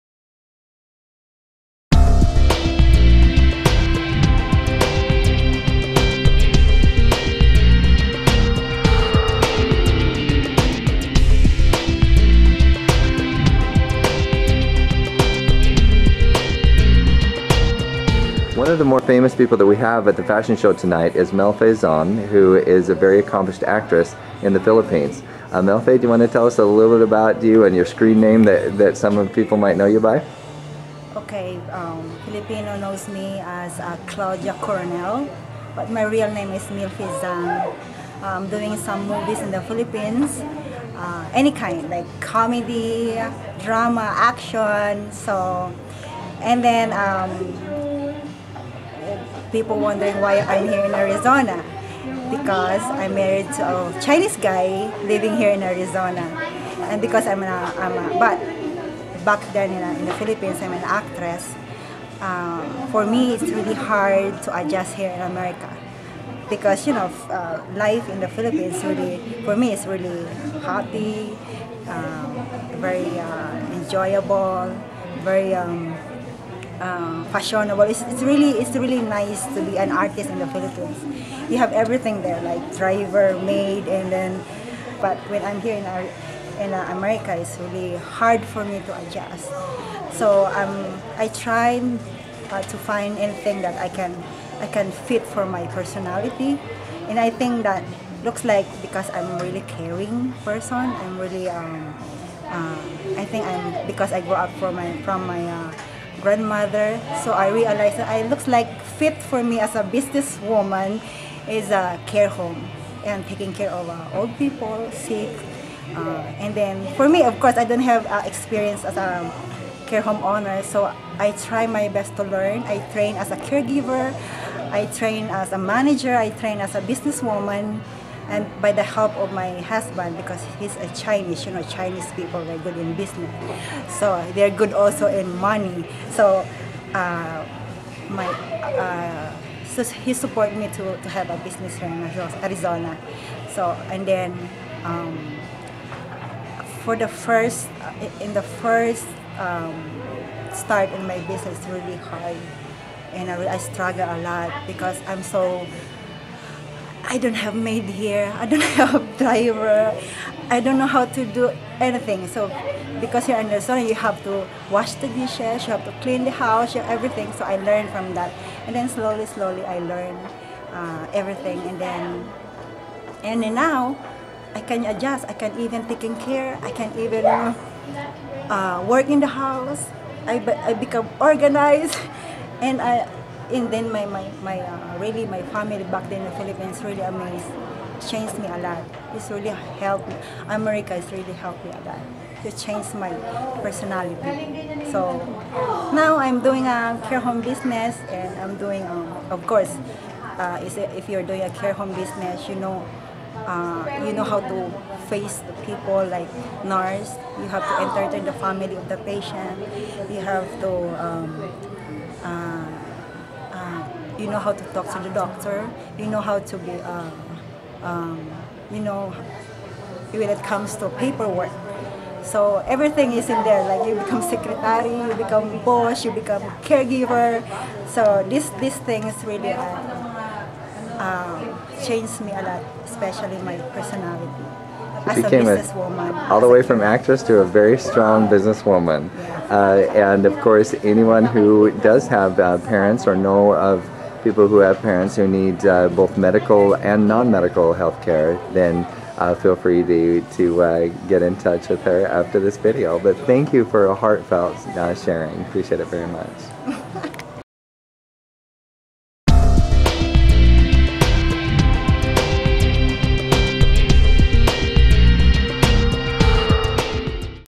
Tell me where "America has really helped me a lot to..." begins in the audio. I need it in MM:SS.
03:10.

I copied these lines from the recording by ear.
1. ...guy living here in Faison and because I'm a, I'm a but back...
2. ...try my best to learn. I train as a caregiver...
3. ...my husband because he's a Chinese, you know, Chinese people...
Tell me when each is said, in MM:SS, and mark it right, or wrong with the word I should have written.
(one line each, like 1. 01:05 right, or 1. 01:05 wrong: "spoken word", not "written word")
1. 00:54 wrong: "Arizona", not "Faison"
2. 02:01 right
3. 02:09 right.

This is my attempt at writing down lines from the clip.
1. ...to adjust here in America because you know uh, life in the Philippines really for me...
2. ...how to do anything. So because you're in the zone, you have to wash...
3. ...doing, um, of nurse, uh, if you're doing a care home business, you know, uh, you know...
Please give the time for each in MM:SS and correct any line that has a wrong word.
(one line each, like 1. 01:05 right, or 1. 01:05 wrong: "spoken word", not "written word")
1. 01:04 right
2. 02:40 right
3. 03:18 wrong: "course", not "nurse".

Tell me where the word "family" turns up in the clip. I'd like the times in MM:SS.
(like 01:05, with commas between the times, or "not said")
03:05, 03:28.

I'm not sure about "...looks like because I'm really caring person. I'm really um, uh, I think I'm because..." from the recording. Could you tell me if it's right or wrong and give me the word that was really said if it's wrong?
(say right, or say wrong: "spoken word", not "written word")
right.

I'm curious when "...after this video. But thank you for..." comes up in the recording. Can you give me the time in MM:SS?
04:12.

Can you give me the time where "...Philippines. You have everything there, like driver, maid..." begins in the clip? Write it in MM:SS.
01:20.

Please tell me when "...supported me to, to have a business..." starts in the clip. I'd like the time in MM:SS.
02:20.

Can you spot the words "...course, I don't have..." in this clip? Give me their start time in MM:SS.
01:57.